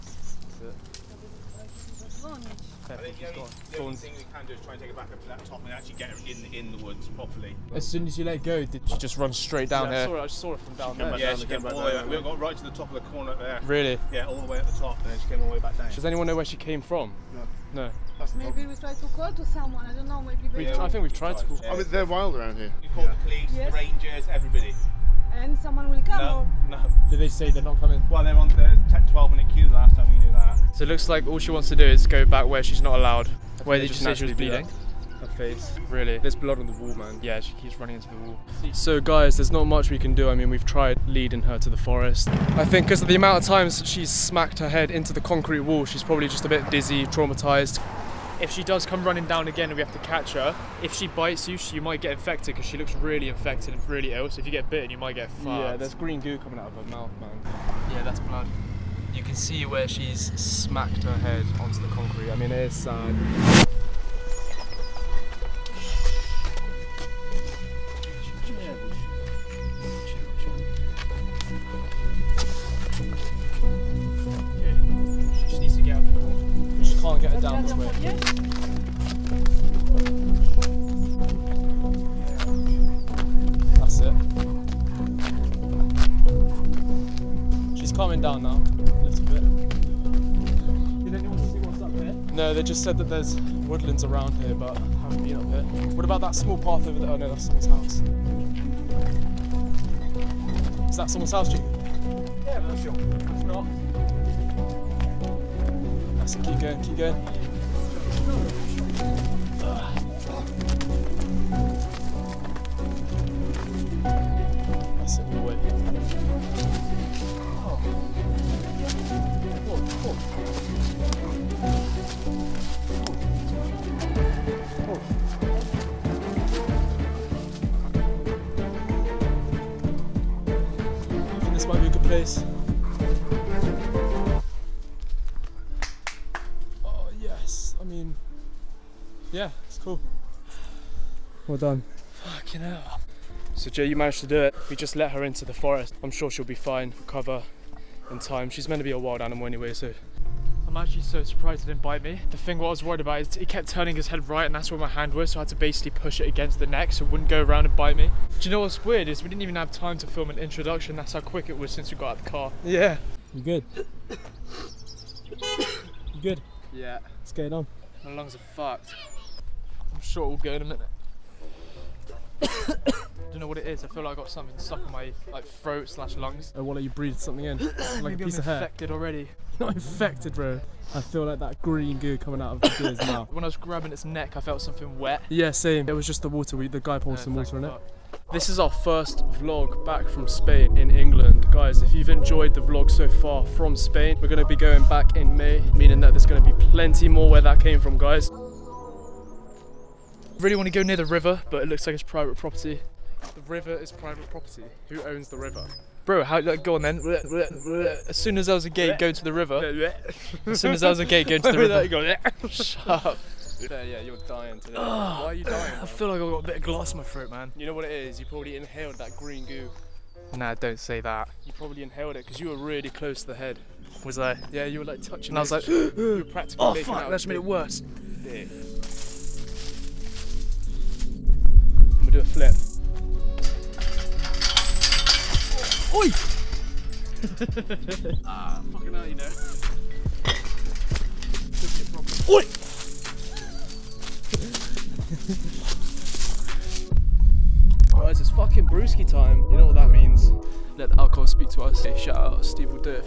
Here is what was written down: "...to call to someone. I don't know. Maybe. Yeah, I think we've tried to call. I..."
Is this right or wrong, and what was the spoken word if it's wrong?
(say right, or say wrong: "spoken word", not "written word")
right.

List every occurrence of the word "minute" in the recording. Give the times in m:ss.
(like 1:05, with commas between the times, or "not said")
0:29, 2:50.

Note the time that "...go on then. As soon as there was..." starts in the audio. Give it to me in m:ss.
3:26.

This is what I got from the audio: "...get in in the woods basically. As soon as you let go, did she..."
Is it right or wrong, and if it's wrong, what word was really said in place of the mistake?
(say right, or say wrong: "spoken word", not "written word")
wrong: "properly", not "basically".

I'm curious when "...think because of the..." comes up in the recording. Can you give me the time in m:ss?
0:42.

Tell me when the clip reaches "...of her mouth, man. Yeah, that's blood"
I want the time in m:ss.
0:56.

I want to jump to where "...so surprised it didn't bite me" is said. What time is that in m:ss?
2:31.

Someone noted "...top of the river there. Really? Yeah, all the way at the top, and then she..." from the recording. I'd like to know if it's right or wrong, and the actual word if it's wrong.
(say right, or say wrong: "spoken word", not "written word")
wrong: "corner", not "river".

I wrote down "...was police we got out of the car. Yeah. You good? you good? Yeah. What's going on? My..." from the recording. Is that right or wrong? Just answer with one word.
wrong.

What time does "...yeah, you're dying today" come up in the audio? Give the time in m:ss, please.
3:33.